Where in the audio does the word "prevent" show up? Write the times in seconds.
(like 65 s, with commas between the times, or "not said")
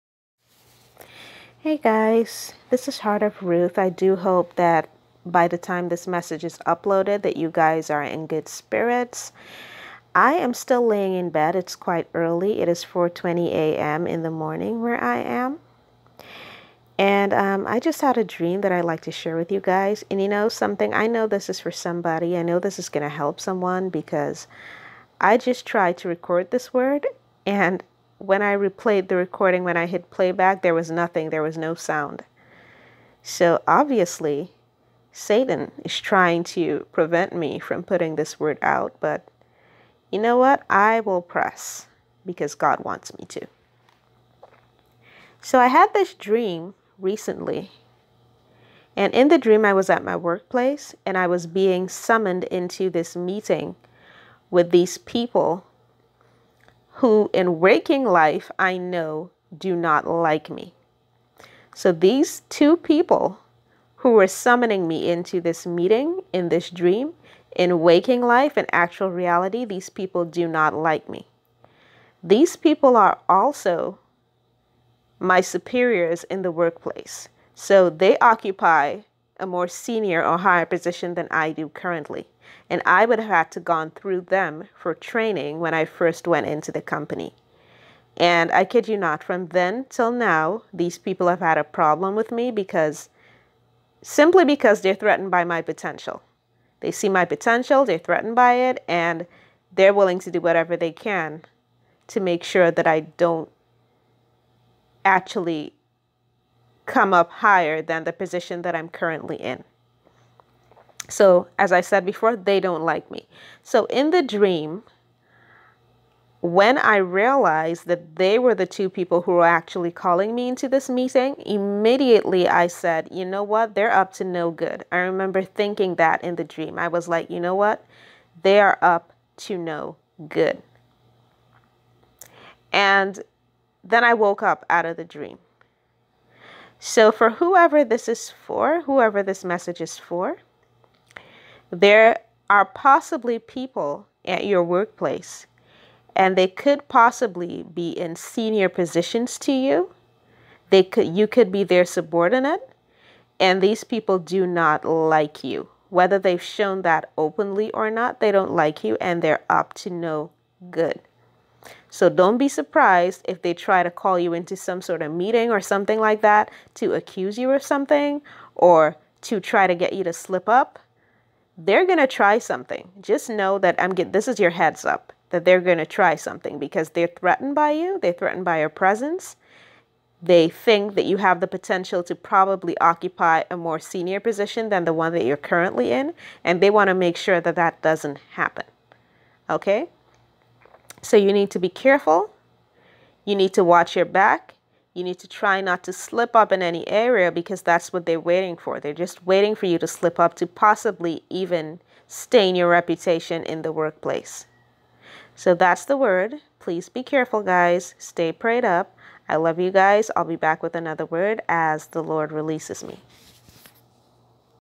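36 s.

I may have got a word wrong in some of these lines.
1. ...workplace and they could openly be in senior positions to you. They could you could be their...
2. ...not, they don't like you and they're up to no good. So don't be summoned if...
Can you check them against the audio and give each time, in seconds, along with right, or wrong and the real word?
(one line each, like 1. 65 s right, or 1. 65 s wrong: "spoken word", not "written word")
1. 144 s wrong: "possibly", not "openly"
2. 157 s wrong: "surprised", not "summoned".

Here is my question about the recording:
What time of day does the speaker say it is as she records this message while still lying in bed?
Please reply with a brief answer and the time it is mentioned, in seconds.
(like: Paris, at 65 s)
4:20 a.m., at 12 s.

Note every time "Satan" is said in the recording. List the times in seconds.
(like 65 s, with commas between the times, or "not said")
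35 s.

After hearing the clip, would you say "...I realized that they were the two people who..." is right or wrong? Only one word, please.
right.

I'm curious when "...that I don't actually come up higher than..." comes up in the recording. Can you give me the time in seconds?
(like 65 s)
102 s.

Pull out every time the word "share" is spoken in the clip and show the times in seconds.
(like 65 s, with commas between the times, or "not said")
19 s.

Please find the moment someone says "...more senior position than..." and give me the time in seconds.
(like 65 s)
183 s.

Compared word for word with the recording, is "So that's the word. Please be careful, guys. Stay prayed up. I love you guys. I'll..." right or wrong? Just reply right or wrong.
right.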